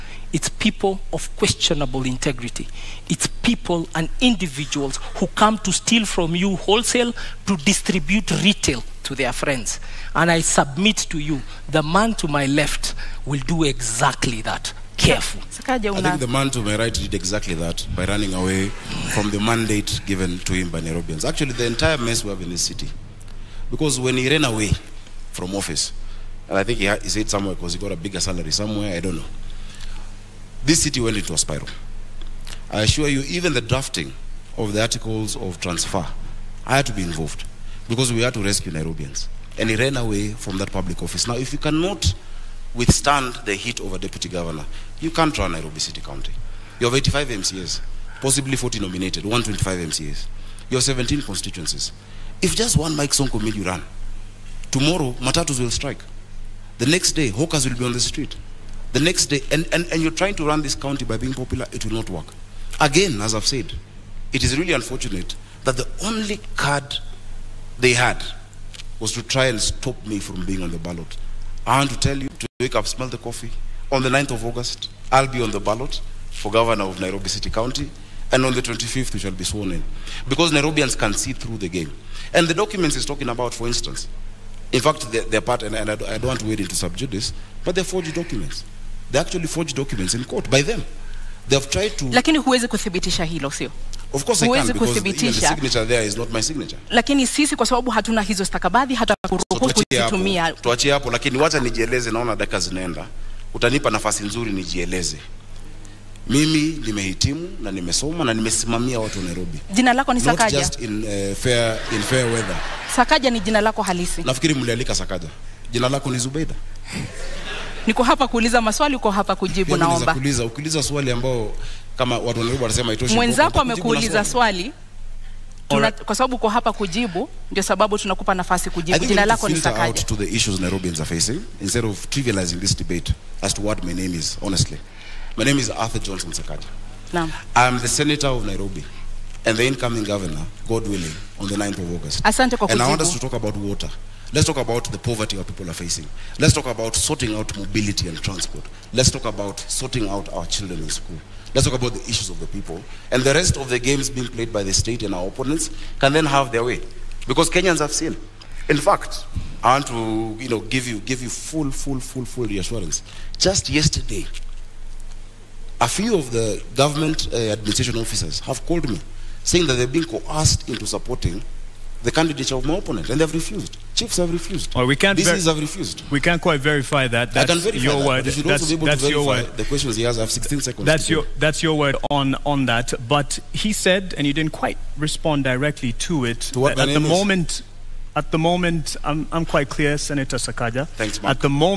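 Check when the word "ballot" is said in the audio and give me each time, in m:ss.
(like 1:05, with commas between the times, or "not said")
1:10, 1:15.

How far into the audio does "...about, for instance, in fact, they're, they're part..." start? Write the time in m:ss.
1:23.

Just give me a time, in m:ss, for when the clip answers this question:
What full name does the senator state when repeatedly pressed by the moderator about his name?
2:15.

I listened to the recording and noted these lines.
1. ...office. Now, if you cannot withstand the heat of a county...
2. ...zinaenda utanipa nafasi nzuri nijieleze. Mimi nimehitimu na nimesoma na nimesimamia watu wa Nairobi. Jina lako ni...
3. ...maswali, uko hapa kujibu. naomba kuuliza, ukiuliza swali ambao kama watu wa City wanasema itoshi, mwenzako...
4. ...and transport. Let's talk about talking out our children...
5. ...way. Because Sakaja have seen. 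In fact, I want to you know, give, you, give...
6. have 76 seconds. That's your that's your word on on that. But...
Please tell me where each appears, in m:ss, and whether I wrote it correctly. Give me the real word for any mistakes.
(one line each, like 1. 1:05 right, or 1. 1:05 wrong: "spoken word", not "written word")
1. 0:41 wrong: "deputy", not "county"
2. 1:42 right
3. 1:58 wrong: "Nairobi", not "City"
4. 2:28 wrong: "sorting", not "talking"
5. 2:36 wrong: "Kenyans", not "Sakaja"
6. 3:00 wrong: "16", not "76".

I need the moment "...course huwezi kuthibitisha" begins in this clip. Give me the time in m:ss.
1:34.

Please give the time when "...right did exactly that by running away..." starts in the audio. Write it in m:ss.
0:16.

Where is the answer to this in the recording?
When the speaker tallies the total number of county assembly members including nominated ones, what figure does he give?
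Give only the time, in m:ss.
0:49.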